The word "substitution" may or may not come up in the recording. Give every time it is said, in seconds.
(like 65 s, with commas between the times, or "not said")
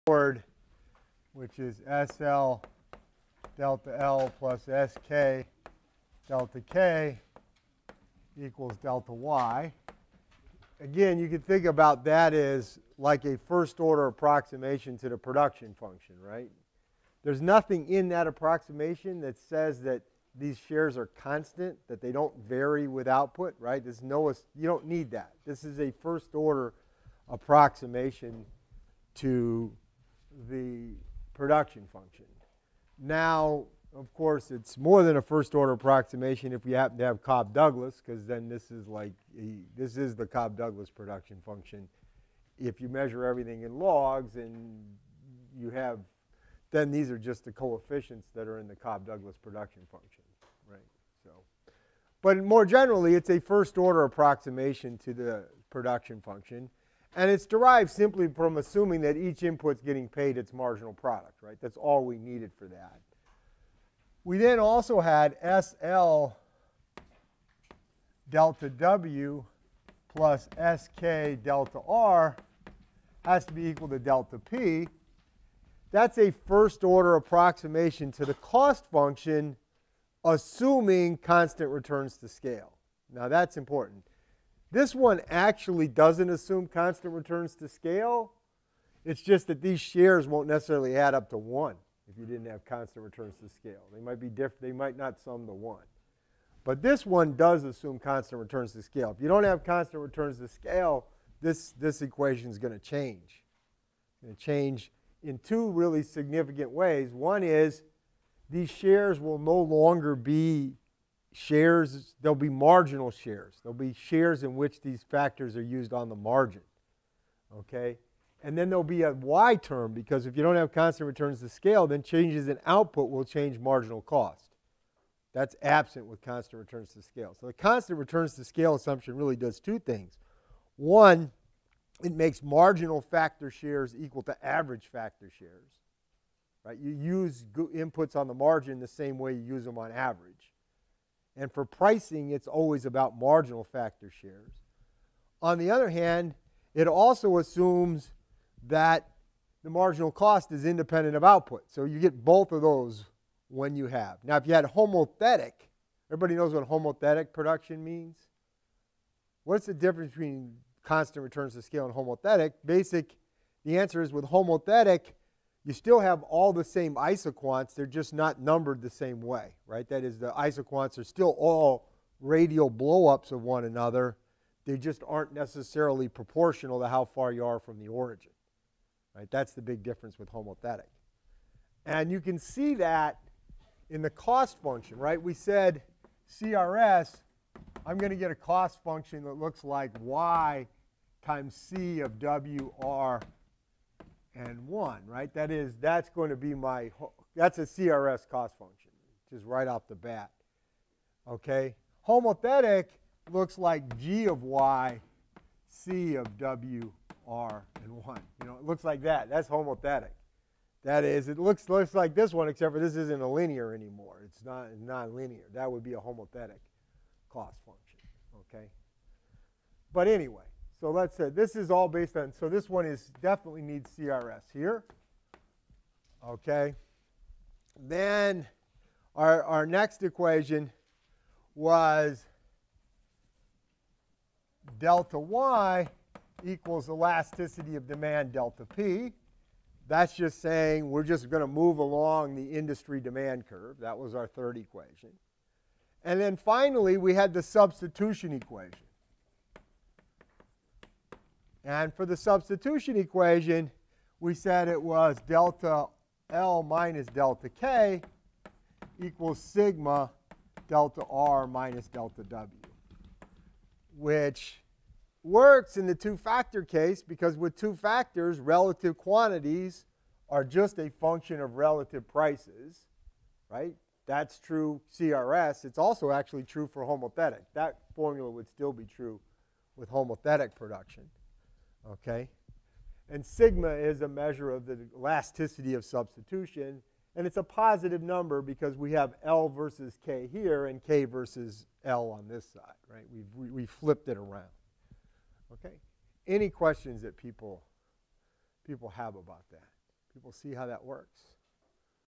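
247 s, 252 s, 285 s.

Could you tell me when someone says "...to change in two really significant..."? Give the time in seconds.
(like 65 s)
104 s.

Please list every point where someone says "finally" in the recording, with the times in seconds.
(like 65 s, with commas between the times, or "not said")
246 s.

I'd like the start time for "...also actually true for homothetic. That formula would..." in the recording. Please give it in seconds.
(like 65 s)
275 s.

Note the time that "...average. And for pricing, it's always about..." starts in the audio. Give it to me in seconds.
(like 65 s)
139 s.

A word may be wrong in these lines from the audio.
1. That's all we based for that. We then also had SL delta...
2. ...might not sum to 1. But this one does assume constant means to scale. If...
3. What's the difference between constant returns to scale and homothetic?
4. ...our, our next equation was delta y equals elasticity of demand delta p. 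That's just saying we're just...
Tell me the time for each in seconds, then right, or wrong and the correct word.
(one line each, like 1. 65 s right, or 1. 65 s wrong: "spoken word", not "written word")
1. 61 s wrong: "needed", not "based"
2. 94 s wrong: "returns", not "means"
3. 159 s right
4. 229 s right.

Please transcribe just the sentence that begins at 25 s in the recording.
This is a first order approximation to the production function.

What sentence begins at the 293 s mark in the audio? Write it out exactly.
We've, we, we flipped it around, okay?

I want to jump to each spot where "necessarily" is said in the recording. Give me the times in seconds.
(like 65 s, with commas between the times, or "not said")
90 s, 175 s.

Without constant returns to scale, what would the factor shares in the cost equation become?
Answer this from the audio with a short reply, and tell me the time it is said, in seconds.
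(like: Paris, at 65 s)
marginal shares, at 112 s.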